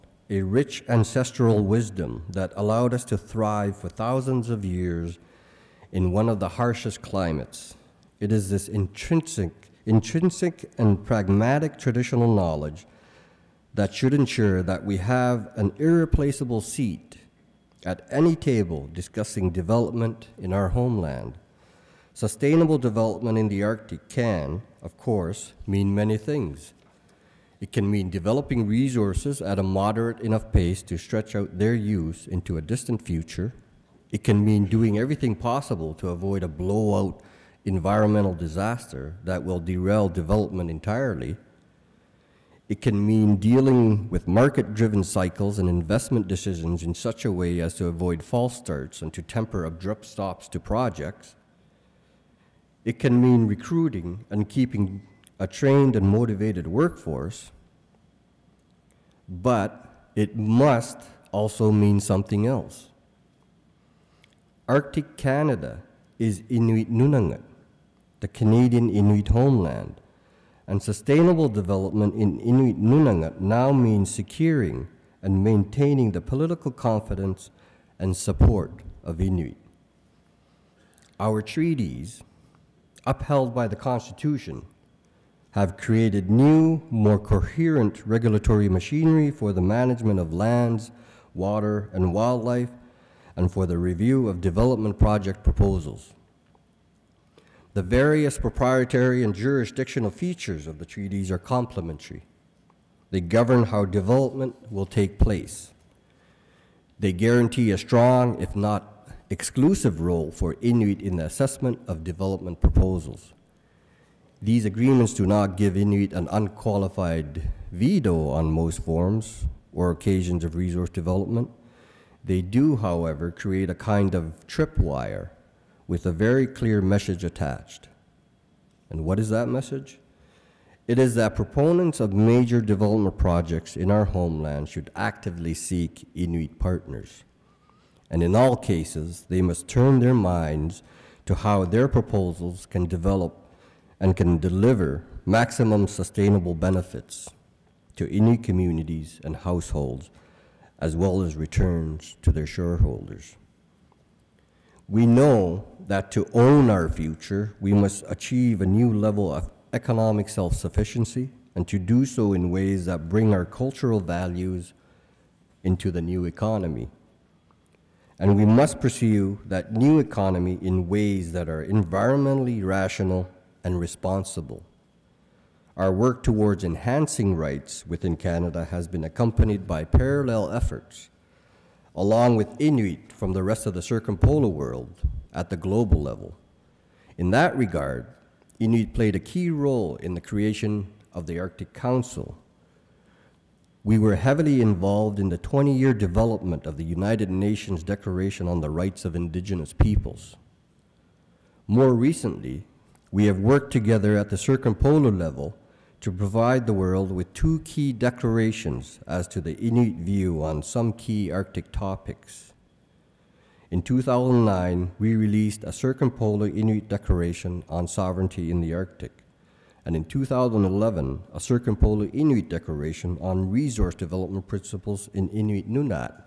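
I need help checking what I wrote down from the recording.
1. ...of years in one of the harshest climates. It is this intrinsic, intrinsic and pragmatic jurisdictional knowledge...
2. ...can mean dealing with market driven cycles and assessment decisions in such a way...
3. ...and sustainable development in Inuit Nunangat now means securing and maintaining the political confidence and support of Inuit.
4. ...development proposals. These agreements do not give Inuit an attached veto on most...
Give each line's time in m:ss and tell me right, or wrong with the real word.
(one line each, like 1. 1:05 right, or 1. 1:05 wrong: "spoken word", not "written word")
1. 0:04 wrong: "traditional", not "jurisdictional"
2. 0:42 wrong: "investment", not "assessment"
3. 1:10 right
4. 1:52 wrong: "unqualified", not "attached".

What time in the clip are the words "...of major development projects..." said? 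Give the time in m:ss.
2:11.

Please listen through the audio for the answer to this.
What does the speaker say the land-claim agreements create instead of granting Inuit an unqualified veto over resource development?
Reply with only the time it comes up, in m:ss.
2:03.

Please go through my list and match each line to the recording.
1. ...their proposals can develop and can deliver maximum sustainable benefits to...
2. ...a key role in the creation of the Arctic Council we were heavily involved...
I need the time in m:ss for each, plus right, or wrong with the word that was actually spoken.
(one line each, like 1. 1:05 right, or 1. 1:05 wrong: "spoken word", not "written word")
1. 2:21 right
2. 3:09 right.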